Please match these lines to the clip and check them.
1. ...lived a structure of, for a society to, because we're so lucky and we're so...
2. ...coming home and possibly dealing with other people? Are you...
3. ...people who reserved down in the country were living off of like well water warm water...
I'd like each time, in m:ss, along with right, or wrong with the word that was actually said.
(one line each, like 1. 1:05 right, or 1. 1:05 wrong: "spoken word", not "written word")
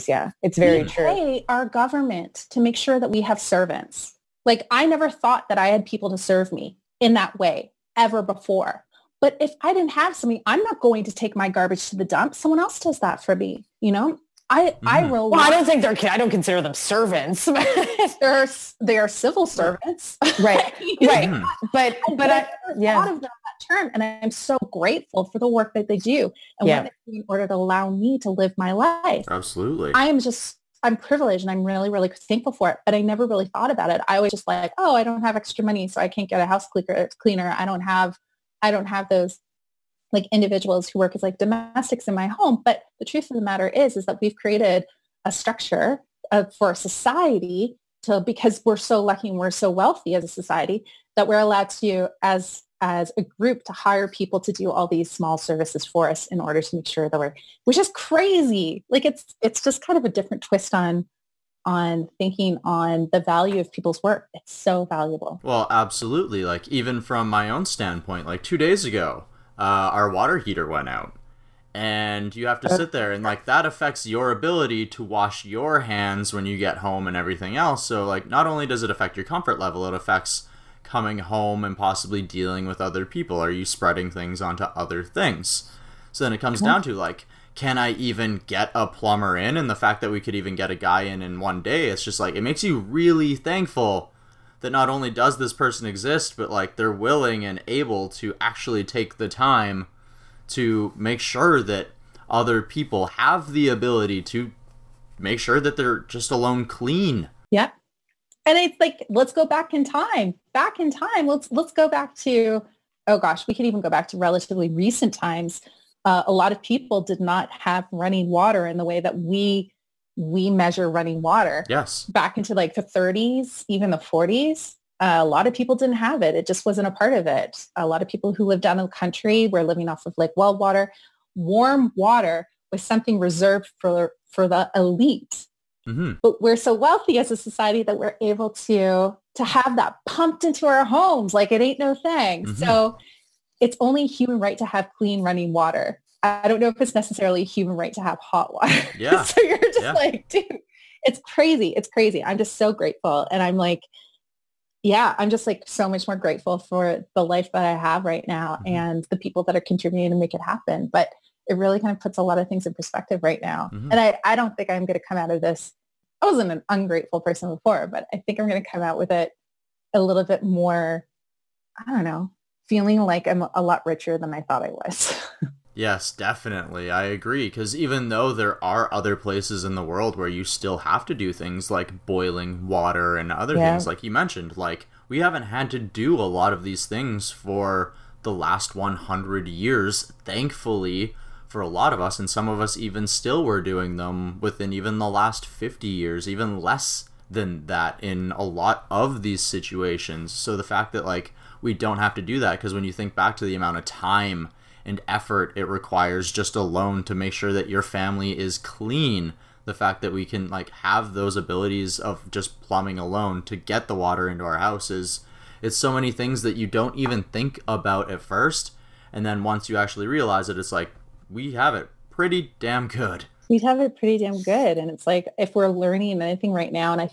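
1. 0:44 wrong: "created", not "lived"
2. 1:20 right
3. 2:08 wrong: "lived", not "reserved".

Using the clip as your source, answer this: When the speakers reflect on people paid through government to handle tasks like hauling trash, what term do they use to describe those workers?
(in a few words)
civil servants.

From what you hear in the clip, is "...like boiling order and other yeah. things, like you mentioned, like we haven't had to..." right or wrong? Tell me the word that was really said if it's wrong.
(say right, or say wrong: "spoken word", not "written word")
wrong: "water", not "order".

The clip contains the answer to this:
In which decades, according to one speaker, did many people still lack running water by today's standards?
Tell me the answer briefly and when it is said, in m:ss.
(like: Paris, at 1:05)
the 30s and 40s, at 2:02.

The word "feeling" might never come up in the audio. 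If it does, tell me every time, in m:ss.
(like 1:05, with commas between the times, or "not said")
2:52.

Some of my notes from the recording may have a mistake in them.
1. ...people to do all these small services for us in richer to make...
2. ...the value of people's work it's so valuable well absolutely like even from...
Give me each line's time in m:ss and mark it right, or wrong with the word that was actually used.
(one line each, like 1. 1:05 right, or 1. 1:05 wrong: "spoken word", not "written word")
1. 0:54 wrong: "order", not "richer"
2. 1:03 right.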